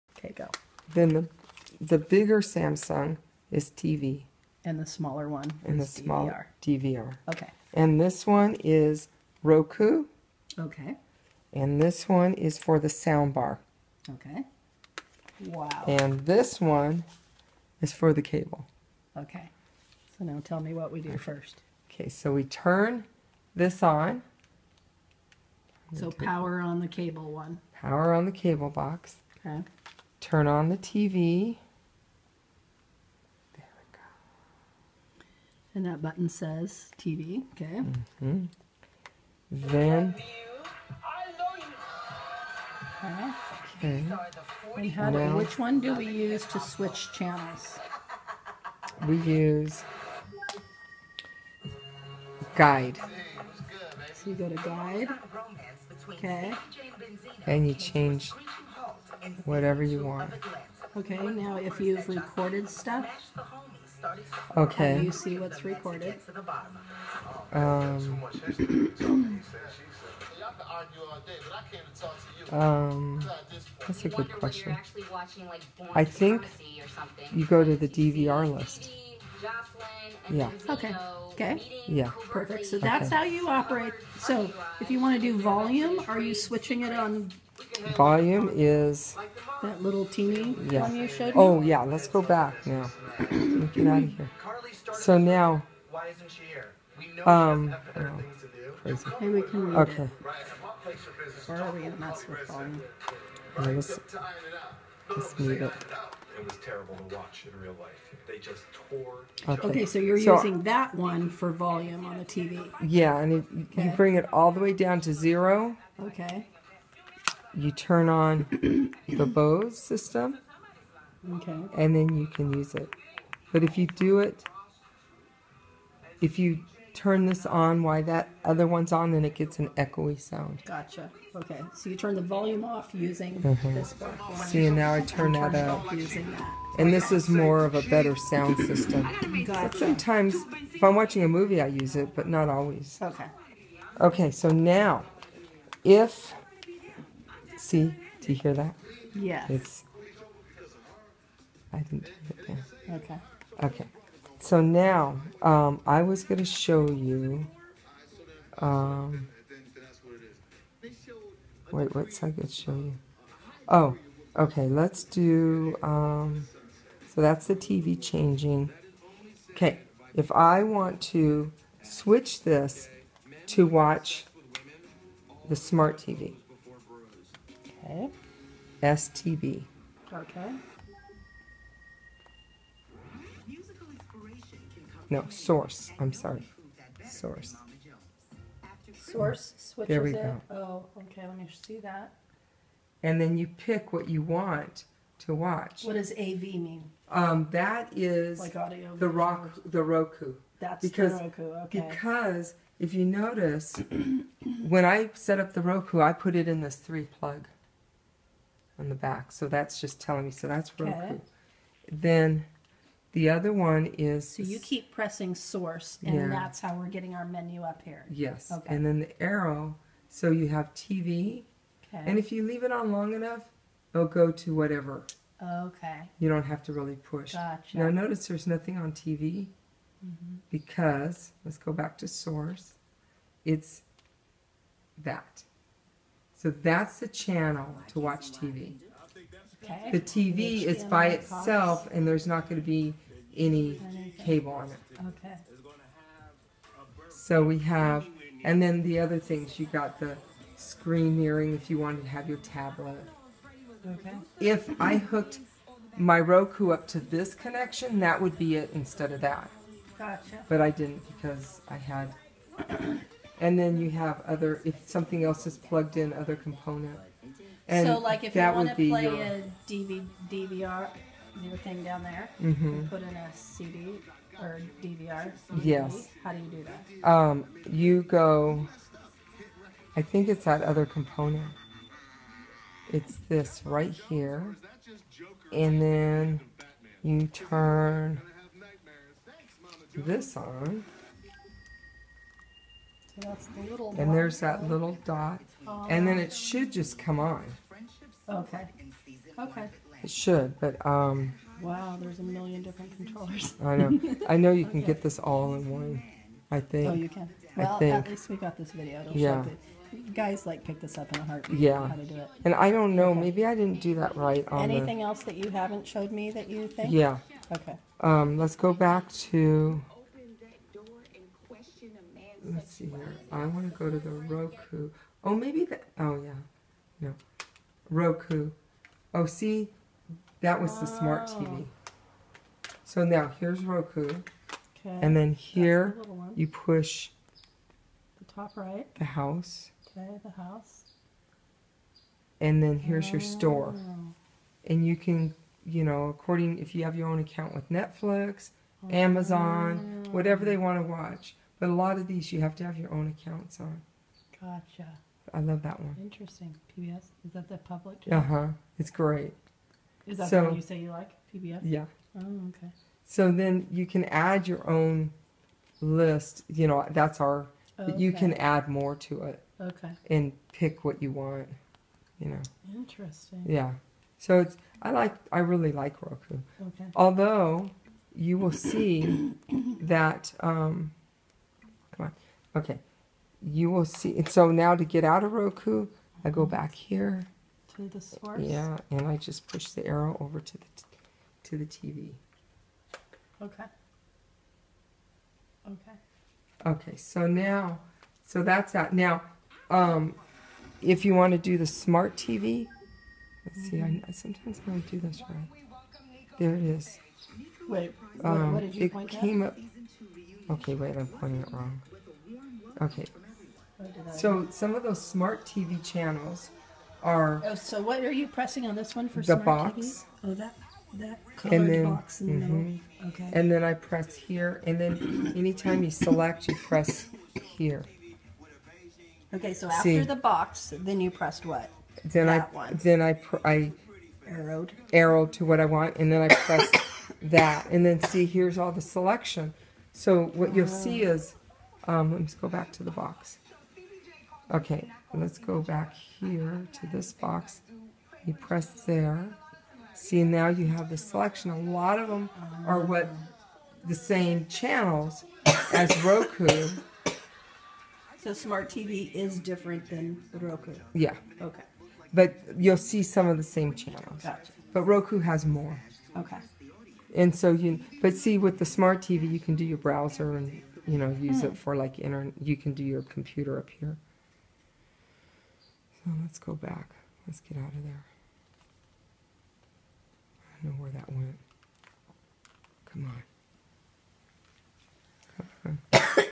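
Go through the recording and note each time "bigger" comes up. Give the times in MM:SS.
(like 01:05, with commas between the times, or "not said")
00:01.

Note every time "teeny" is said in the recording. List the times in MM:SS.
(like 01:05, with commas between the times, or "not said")
01:30.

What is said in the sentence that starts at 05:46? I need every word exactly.
If you have your own account with Netflix, oh.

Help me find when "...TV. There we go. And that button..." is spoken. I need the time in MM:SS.
00:30.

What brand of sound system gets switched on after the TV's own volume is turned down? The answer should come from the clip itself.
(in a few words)
Bose.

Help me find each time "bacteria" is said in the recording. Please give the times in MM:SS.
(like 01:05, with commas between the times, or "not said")
not said.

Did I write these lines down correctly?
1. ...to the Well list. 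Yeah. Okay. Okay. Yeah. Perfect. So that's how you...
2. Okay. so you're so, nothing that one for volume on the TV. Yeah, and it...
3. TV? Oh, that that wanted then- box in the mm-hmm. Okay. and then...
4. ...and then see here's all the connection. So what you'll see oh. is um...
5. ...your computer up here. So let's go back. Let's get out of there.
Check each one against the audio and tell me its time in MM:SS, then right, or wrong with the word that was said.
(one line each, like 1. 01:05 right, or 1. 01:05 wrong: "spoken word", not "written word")
1. 01:17 wrong: "DVR", not "Well"
2. 01:49 wrong: "using", not "nothing"
3. 06:59 wrong: "colored", not "wanted"
4. 07:17 wrong: "selection", not "connection"
5. 07:52 right.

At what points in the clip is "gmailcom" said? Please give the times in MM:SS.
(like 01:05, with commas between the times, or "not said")
not said.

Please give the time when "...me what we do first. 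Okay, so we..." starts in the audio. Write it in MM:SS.
00:20.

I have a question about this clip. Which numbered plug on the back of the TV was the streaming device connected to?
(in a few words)
3.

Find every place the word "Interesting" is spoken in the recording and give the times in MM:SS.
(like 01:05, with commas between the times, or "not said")
05:56, 06:12.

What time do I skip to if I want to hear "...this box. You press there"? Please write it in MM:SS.
07:26.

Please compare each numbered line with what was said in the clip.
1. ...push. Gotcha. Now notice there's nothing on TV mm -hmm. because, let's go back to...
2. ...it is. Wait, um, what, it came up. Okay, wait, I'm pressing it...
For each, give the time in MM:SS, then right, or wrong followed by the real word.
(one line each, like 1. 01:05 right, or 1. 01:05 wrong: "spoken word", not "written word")
1. 03:46 right
2. 06:46 wrong: "pointing", not "pressing".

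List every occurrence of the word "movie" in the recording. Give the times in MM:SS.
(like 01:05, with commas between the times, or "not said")
02:21.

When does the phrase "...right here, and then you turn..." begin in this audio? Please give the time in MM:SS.
04:43.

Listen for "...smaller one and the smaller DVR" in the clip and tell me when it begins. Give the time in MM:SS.
00:04.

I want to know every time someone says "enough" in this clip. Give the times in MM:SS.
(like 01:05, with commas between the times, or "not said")
03:43.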